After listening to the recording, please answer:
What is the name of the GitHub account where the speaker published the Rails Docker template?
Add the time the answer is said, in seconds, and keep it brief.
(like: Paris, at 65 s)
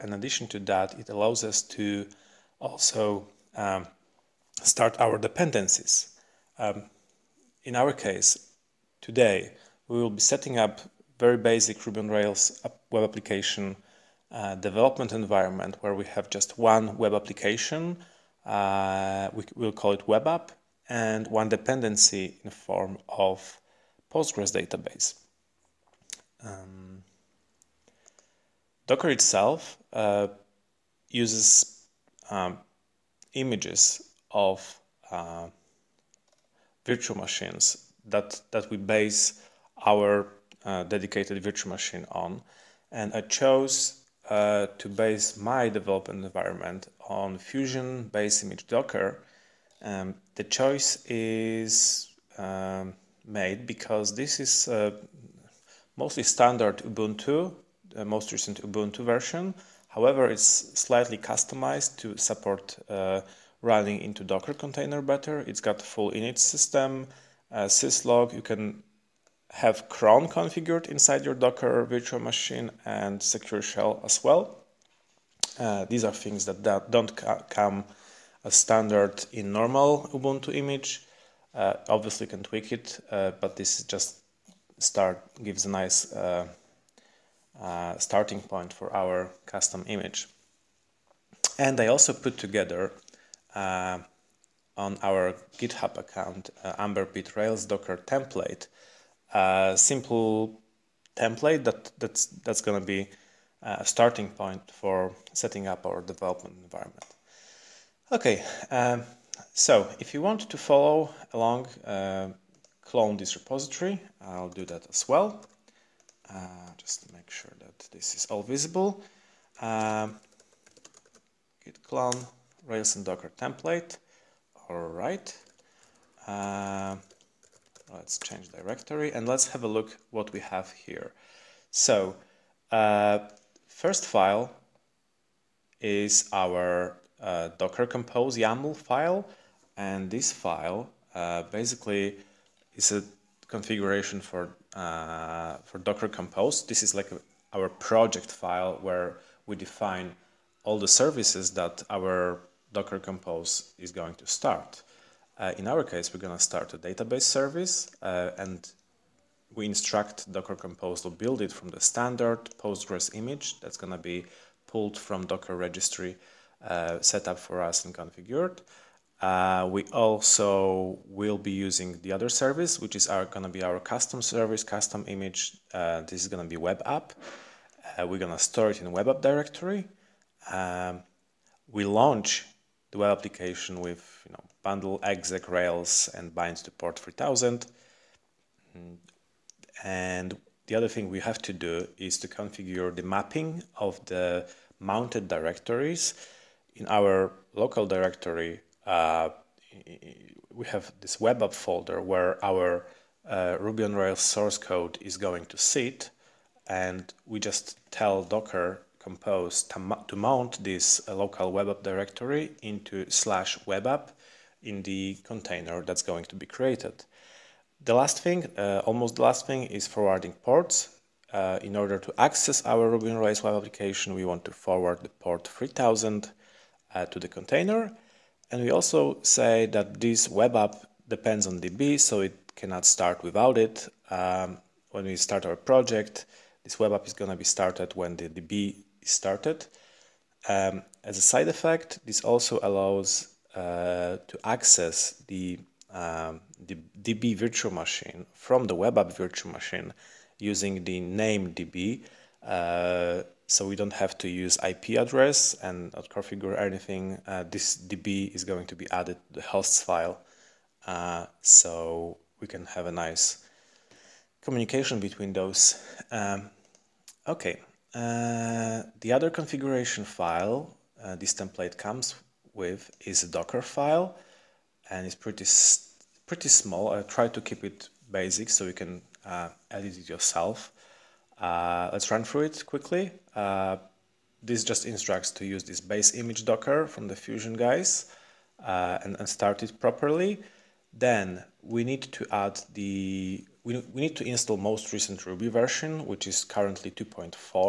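AmberBit, at 96 s.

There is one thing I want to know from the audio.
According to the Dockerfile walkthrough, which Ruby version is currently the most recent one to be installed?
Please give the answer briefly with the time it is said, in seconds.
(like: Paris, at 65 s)
2.4, at 296 s.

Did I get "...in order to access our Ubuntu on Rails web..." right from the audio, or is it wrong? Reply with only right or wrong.
wrong.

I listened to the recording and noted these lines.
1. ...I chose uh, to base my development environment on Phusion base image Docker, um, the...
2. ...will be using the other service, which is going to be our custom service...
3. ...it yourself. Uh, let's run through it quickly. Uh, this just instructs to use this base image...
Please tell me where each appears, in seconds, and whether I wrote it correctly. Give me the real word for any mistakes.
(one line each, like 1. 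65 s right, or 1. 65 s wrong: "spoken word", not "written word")
1. 43 s right
2. 171 s right
3. 279 s right.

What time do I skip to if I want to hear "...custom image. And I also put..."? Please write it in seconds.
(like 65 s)
89 s.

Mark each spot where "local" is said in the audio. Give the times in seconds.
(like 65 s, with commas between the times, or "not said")
197 s, 211 s.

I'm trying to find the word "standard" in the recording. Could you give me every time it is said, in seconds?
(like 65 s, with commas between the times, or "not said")
56 s, 78 s, 161 s.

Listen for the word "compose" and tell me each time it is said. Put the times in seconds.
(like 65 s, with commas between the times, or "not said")
137 s, 146 s, 152 s, 160 s, 209 s.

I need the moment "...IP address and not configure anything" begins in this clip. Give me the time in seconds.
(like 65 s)
254 s.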